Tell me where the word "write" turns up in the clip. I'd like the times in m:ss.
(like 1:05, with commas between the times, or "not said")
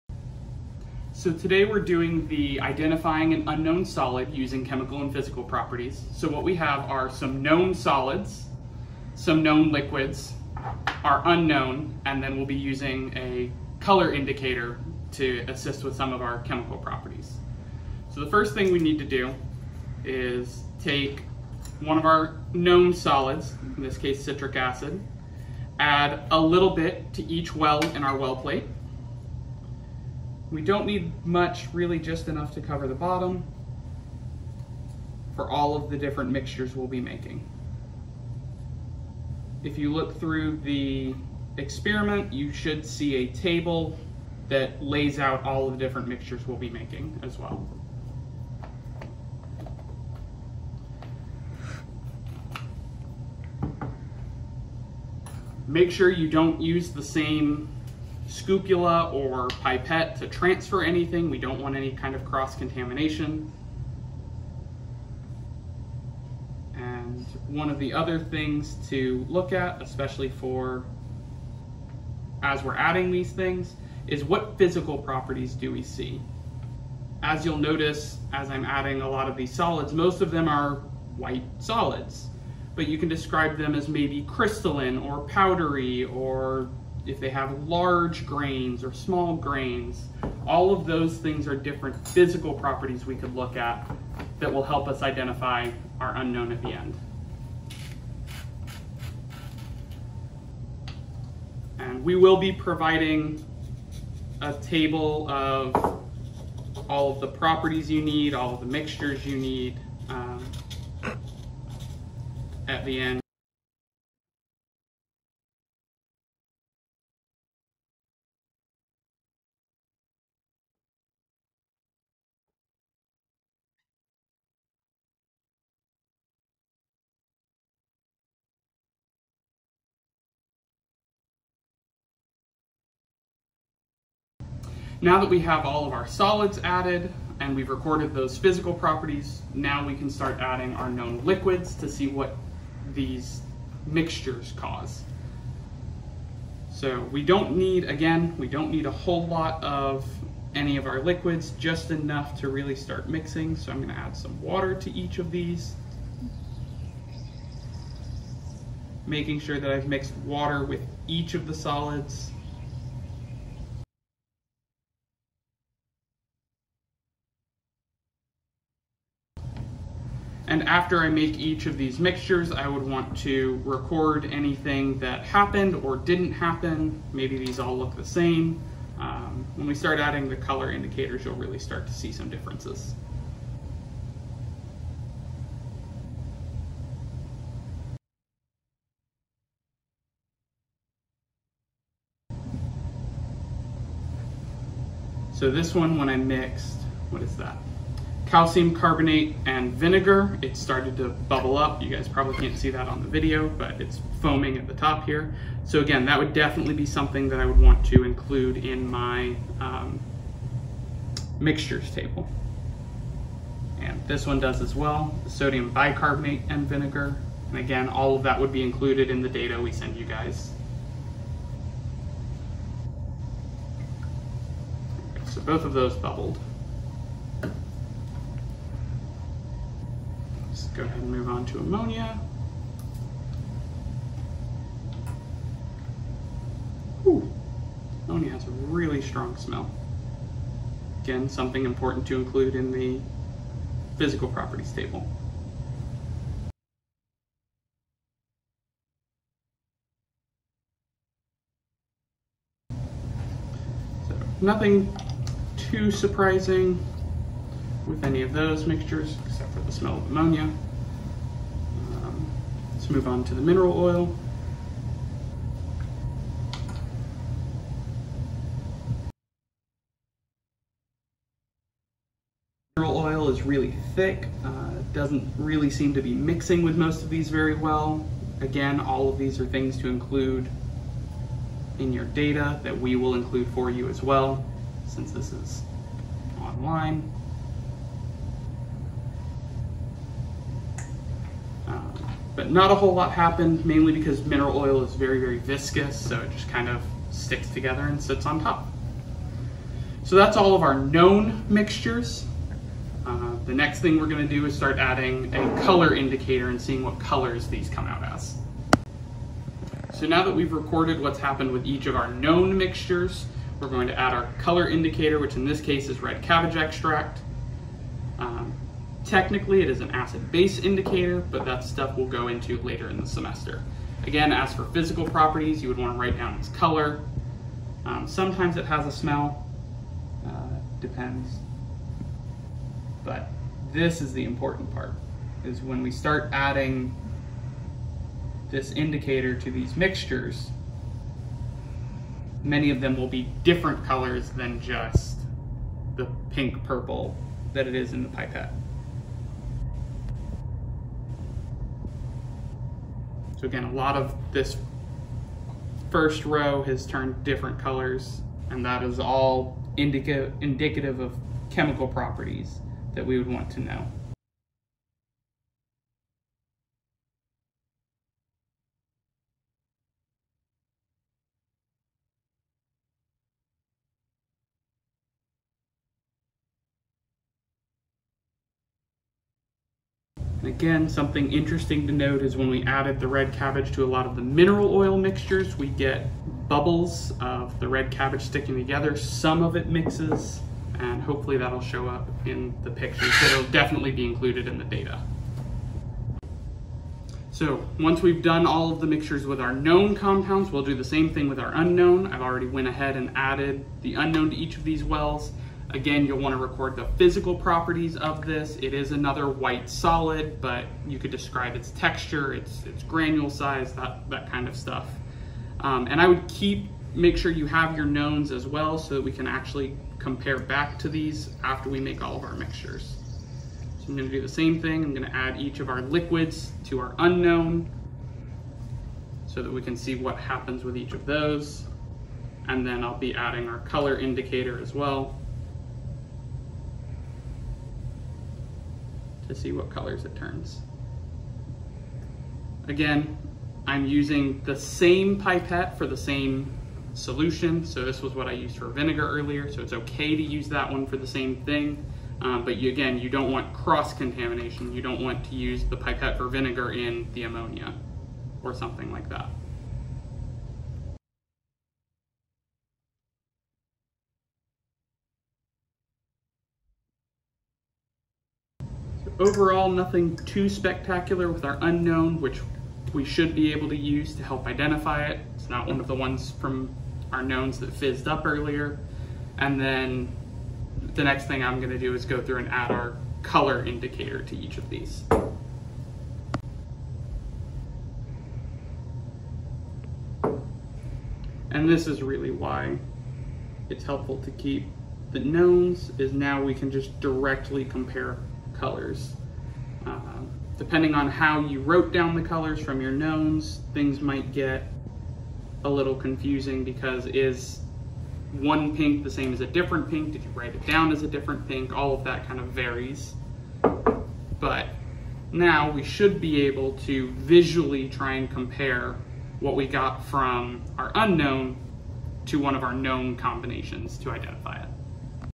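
5:25, 8:30.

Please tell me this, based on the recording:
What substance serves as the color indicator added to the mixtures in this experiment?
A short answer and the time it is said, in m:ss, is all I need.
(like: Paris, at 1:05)
red cabbage extract, at 5:16.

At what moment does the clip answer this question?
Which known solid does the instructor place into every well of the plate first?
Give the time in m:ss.
0:24.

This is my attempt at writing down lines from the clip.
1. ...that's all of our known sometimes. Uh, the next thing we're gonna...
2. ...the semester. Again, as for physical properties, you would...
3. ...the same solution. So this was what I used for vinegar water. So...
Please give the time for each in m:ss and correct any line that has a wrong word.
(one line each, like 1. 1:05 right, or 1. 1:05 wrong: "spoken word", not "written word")
1. 5:00 wrong: "mixtures", not "sometimes"
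2. 5:22 right
3. 7:25 wrong: "earlier", not "water".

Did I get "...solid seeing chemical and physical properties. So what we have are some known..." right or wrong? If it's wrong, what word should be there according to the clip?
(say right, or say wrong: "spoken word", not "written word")
wrong: "using", not "seeing".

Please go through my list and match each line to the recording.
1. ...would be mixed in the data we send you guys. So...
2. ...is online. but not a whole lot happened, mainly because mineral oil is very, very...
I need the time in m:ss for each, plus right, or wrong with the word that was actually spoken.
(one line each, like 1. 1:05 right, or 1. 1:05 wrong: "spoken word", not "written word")
1. 3:38 wrong: "included", not "mixed"
2. 4:45 right.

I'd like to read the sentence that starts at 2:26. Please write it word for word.
So we don't need, again, we don't need a whole lot of any of our liquids, just enough to really start mixing.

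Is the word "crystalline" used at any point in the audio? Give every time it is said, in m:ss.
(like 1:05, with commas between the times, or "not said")
1:24.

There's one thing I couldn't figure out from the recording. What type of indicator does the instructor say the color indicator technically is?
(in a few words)
acid-base indicator.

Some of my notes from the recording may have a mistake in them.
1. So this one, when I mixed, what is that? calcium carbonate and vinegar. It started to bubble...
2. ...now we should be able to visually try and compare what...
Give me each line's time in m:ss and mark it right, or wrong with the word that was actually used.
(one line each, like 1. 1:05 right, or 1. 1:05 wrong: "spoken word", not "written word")
1. 3:15 right
2. 8:35 right.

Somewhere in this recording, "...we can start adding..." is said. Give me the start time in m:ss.
2:19.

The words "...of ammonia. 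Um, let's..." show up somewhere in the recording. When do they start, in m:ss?
4:19.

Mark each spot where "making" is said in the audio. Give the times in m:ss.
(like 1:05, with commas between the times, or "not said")
0:36, 0:46, 2:39.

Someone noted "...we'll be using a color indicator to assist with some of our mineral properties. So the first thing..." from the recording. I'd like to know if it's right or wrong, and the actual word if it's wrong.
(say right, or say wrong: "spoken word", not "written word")
wrong: "chemical", not "mineral".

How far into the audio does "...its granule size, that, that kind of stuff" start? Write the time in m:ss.
6:52.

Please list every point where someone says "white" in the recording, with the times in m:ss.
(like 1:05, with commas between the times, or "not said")
1:21, 6:49.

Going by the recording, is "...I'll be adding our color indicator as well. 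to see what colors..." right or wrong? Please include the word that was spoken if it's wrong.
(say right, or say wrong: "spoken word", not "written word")
right.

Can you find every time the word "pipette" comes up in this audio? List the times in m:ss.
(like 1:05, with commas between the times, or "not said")
0:59, 5:48, 7:25, 7:35.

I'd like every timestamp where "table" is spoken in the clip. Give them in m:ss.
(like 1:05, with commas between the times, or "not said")
0:43, 1:44, 3:31, 4:04.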